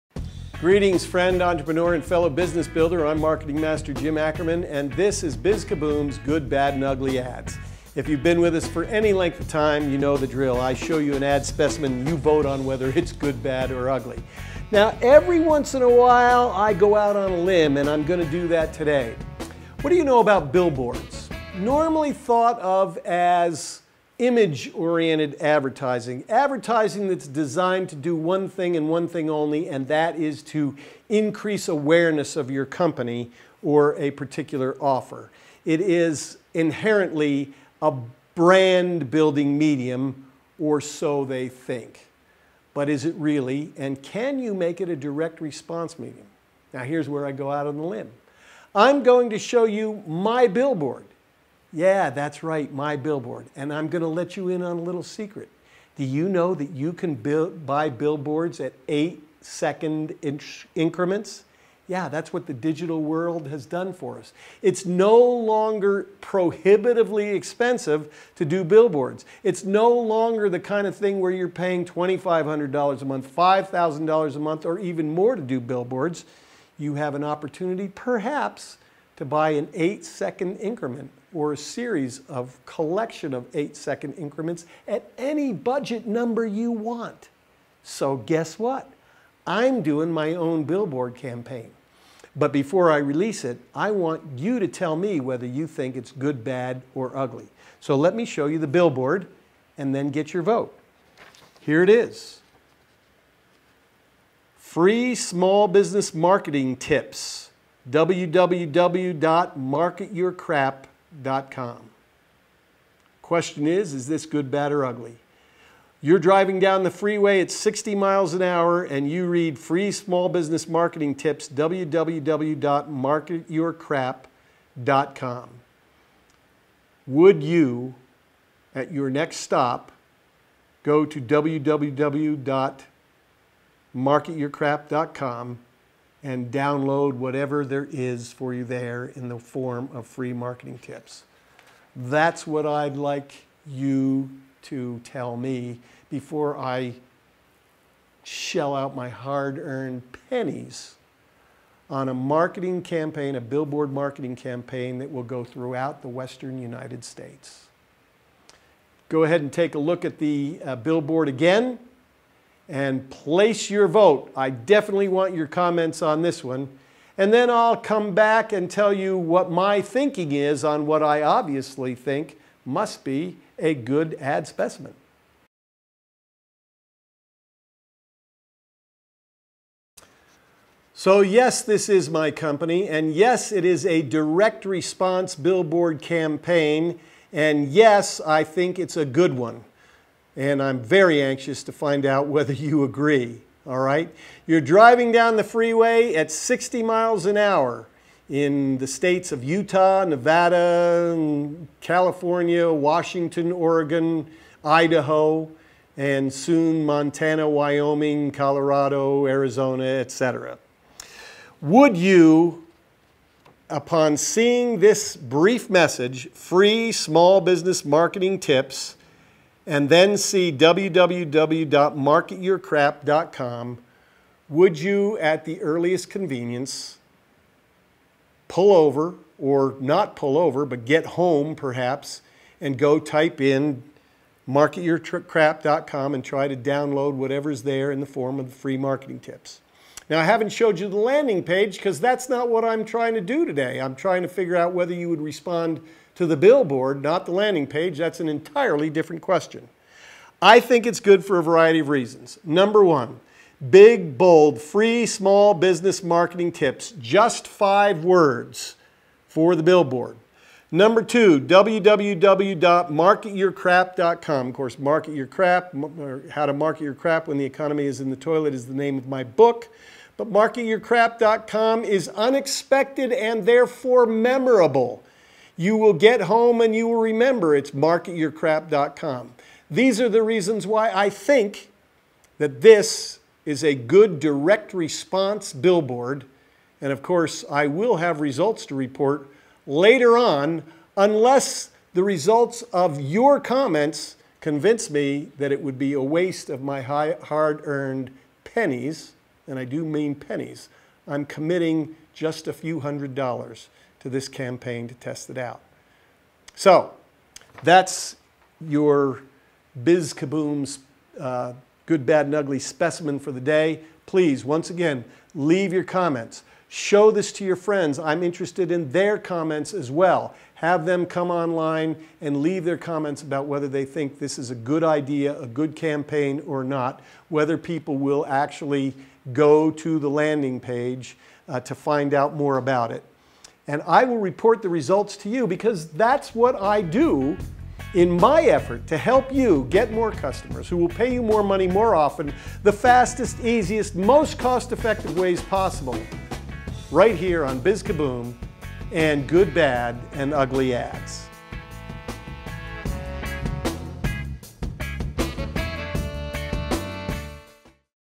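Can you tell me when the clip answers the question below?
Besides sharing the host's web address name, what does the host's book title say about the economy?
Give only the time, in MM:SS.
04:27.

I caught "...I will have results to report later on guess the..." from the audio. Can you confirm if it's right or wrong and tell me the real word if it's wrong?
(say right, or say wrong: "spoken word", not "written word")
wrong: "unless", not "guess".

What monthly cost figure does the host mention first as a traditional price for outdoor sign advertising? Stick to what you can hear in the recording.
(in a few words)
$2,500.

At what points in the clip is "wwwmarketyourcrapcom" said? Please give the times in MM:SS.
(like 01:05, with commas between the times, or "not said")
01:47, 02:01, 02:11, 03:40, 04:21.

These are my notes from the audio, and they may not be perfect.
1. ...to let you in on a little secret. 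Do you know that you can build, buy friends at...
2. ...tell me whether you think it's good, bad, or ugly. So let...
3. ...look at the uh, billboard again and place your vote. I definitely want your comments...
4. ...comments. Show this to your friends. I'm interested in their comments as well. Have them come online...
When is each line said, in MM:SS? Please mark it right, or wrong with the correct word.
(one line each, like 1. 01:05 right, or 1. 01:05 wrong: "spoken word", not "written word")
1. 00:54 wrong: "billboards", not "friends"
2. 01:34 right
3. 02:39 right
4. 05:15 right.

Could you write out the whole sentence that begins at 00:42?
But is it really, and can you make it a direct response medium?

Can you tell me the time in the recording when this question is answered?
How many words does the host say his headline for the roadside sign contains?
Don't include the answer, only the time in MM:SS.
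04:17.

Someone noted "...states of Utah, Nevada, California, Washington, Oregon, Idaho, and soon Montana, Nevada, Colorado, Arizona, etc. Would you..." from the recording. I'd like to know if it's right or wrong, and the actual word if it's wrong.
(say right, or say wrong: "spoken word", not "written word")
wrong: "Wyoming", not "Nevada".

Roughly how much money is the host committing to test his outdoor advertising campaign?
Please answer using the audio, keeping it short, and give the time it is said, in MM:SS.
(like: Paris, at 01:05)
a few hundred dollars, at 05:02.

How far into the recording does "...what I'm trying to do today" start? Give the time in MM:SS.
04:02.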